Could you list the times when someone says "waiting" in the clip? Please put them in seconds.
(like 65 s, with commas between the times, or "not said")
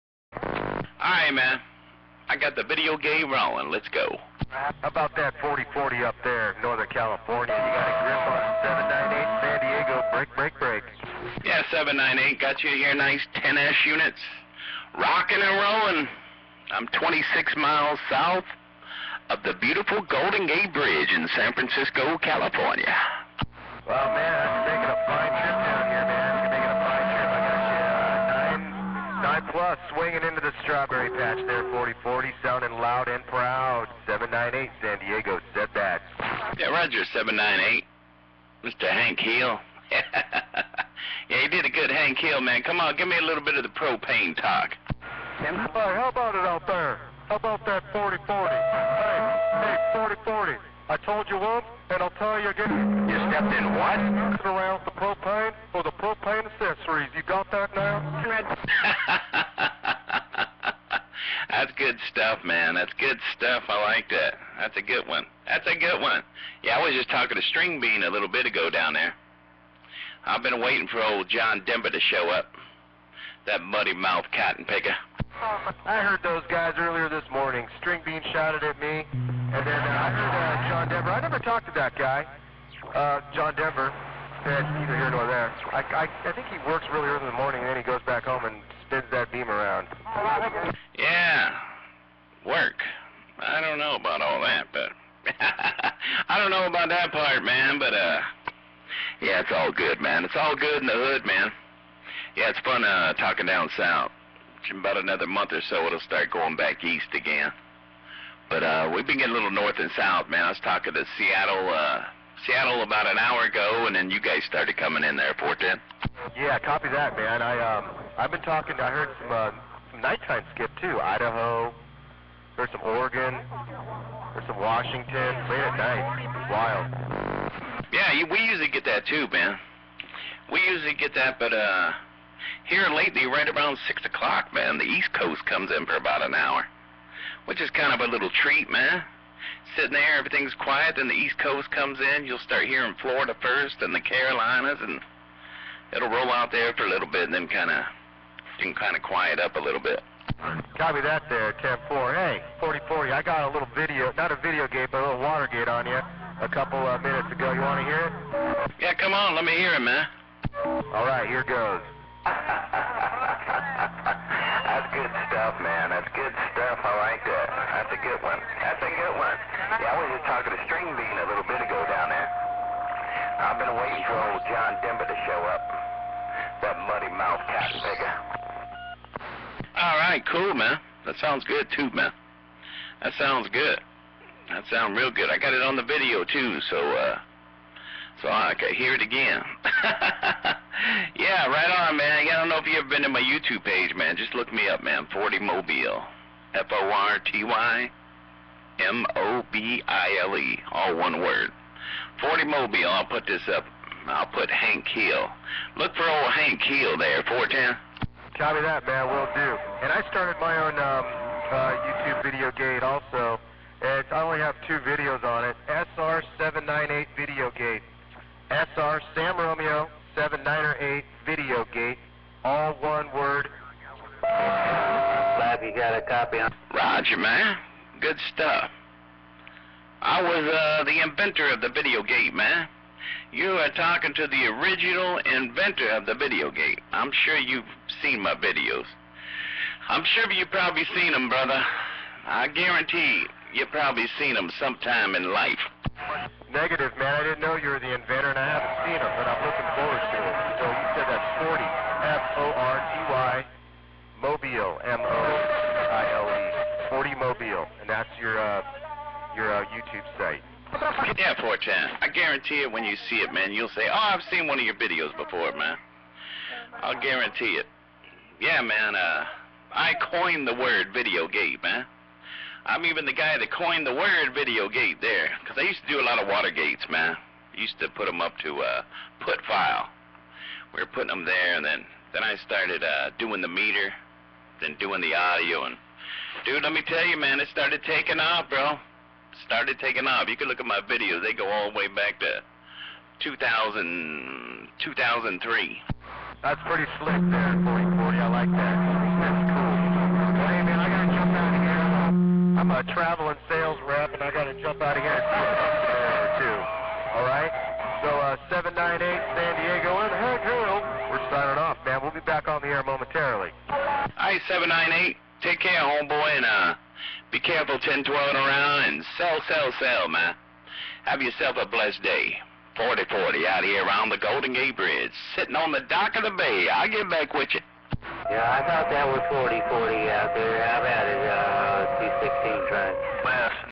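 70 s, 173 s.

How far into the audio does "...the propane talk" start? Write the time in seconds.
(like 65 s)
43 s.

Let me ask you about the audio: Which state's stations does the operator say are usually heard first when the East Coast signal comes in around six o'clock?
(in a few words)
Florida.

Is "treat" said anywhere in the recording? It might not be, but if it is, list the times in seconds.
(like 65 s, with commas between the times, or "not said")
138 s.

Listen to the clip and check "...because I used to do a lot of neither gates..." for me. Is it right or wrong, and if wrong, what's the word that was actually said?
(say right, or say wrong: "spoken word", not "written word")
wrong: "water", not "neither".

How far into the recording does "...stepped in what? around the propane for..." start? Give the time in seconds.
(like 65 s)
53 s.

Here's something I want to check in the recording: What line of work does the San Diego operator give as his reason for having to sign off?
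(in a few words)
Traveling sales rep.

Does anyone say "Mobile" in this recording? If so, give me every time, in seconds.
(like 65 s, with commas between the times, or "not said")
195 s, 202 s.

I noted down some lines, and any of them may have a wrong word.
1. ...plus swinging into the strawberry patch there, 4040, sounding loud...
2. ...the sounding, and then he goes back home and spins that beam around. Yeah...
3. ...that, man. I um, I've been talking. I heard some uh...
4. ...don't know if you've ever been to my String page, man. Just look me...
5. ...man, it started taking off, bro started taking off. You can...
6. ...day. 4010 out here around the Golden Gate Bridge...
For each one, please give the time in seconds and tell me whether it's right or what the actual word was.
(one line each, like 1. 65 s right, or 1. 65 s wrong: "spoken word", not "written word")
1. 29 s right
2. 87 s wrong: "morning", not "sounding"
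3. 116 s right
4. 192 s wrong: "YouTube", not "String"
5. 287 s right
6. 322 s wrong: "4040", not "4010".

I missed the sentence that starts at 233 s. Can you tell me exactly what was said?
You are talking to the original inventor of the video gate.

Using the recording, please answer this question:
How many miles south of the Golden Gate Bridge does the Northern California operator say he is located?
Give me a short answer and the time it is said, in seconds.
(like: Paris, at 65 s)
26, at 16 s.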